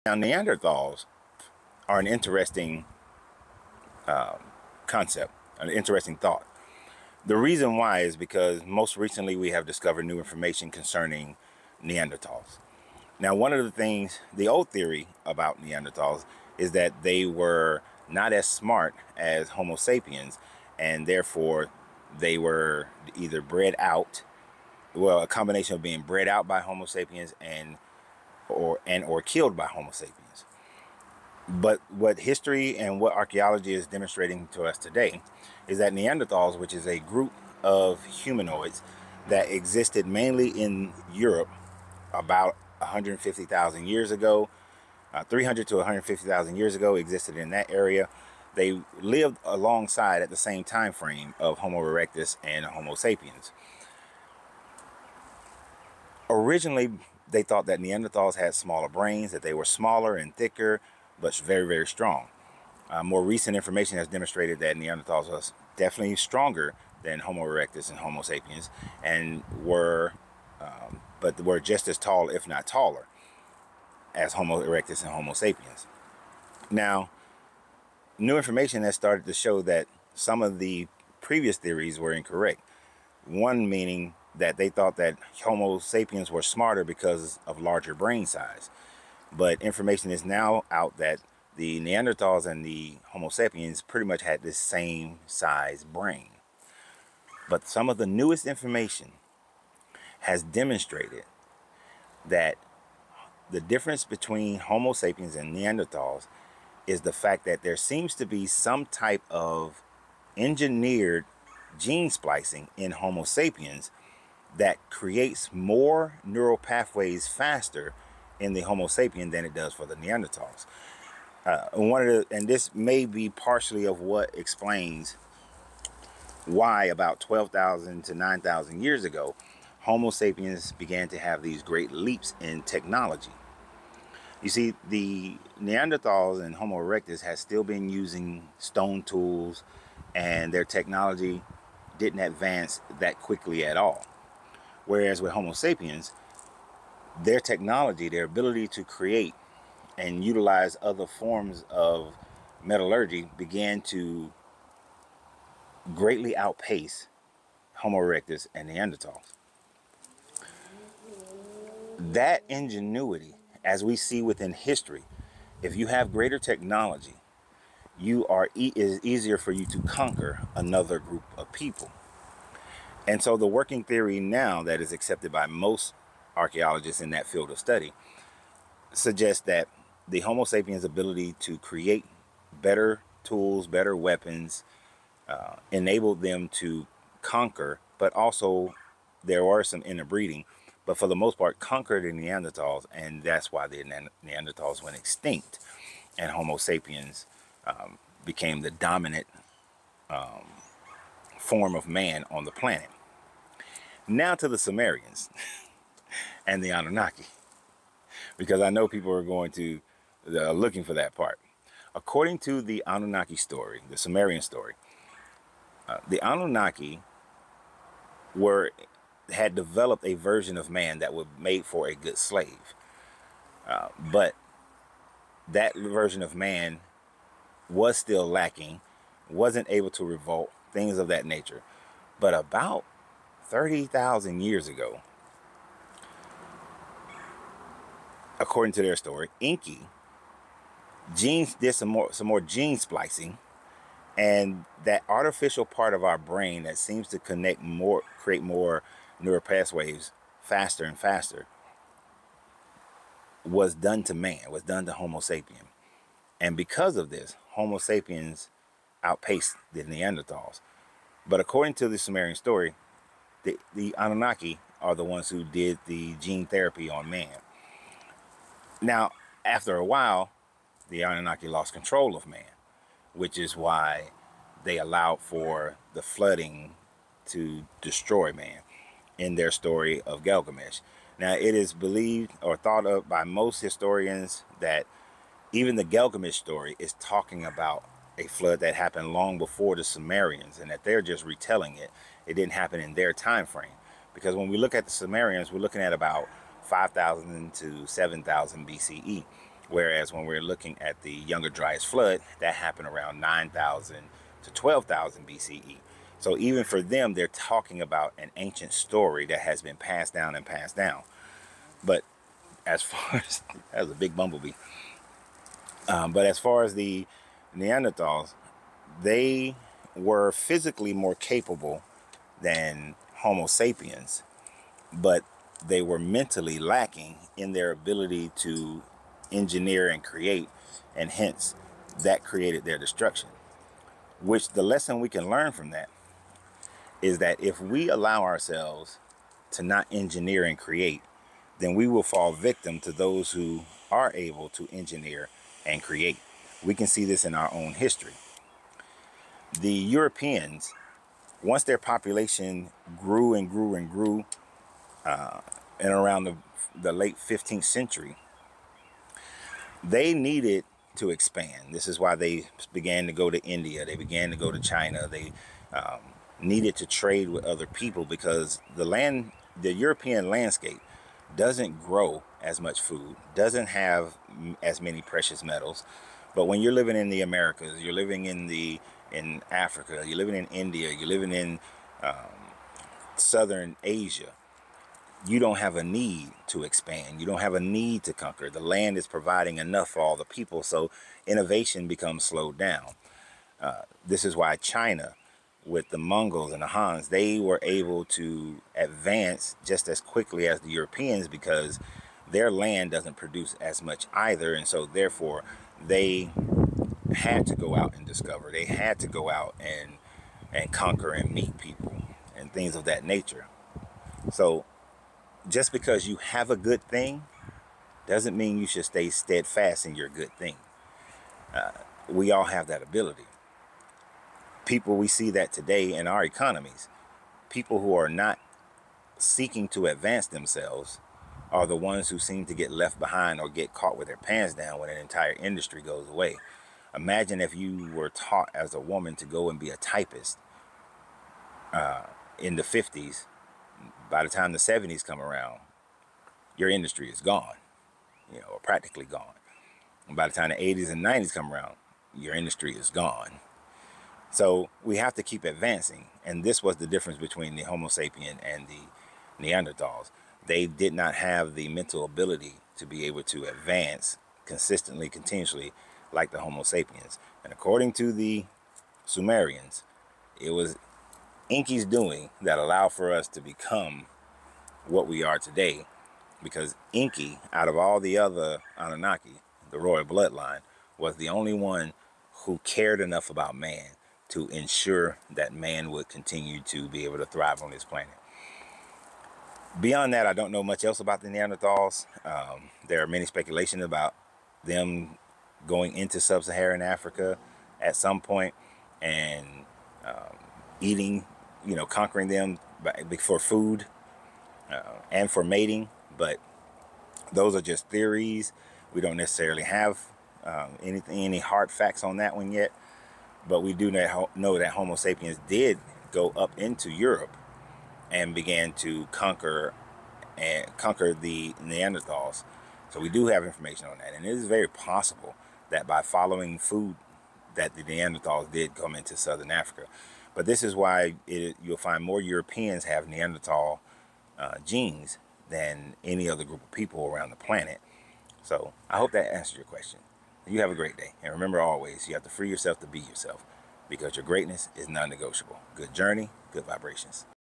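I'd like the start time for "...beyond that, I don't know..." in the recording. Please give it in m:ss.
8:09.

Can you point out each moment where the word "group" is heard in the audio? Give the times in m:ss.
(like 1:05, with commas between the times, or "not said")
0:36, 2:50, 8:56.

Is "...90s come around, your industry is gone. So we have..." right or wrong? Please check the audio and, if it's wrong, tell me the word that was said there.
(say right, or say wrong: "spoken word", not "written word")
right.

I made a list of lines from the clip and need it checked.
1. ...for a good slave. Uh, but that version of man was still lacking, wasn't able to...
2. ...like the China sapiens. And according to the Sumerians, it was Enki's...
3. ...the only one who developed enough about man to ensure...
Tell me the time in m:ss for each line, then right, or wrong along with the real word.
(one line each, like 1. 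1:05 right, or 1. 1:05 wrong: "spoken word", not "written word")
1. 3:41 right
2. 7:46 wrong: "Homo", not "China"
3. 8:01 wrong: "cared", not "developed".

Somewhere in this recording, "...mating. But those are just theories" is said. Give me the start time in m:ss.
8:25.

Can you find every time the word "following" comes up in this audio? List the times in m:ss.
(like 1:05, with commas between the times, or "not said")
8:46.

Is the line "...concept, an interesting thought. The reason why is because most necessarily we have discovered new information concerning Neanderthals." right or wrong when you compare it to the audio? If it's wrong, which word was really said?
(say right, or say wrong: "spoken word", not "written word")
wrong: "recently", not "necessarily".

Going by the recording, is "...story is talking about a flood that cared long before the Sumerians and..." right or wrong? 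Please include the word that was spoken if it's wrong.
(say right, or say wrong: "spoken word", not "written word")
wrong: "happened", not "cared".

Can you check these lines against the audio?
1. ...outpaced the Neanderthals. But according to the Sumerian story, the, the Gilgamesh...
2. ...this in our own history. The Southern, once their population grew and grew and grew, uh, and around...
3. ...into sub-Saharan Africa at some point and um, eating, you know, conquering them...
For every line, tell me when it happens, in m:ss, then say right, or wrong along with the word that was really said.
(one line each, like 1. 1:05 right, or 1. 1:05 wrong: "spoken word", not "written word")
1. 4:19 wrong: "Anunnaki", not "Gilgamesh"
2. 5:47 wrong: "Europeans", not "Southern"
3. 8:15 right.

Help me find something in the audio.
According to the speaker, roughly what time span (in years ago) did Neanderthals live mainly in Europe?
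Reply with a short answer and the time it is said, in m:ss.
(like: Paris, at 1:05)
300,000 to 150,000 years ago, at 0:45.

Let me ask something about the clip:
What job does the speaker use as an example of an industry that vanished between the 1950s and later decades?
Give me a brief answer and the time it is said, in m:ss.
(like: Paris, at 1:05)
Typist, at 7:19.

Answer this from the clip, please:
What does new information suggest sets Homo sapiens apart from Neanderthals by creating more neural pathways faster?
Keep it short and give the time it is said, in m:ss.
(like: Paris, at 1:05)
Engineered gene splicing, at 1:50.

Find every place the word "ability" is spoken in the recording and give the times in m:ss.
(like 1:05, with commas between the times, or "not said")
2:28, 3:00, 5:27, 7:02, 7:42.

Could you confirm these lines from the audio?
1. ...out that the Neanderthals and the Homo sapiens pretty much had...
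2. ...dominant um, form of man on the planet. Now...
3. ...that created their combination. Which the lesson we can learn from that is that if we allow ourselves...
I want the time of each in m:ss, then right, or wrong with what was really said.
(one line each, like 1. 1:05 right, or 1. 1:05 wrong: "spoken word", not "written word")
1. 1:30 right
2. 3:18 right
3. 5:32 wrong: "destruction", not "combination".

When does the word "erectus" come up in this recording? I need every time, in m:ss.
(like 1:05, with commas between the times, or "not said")
0:51, 1:07, 1:14, 2:16, 2:37.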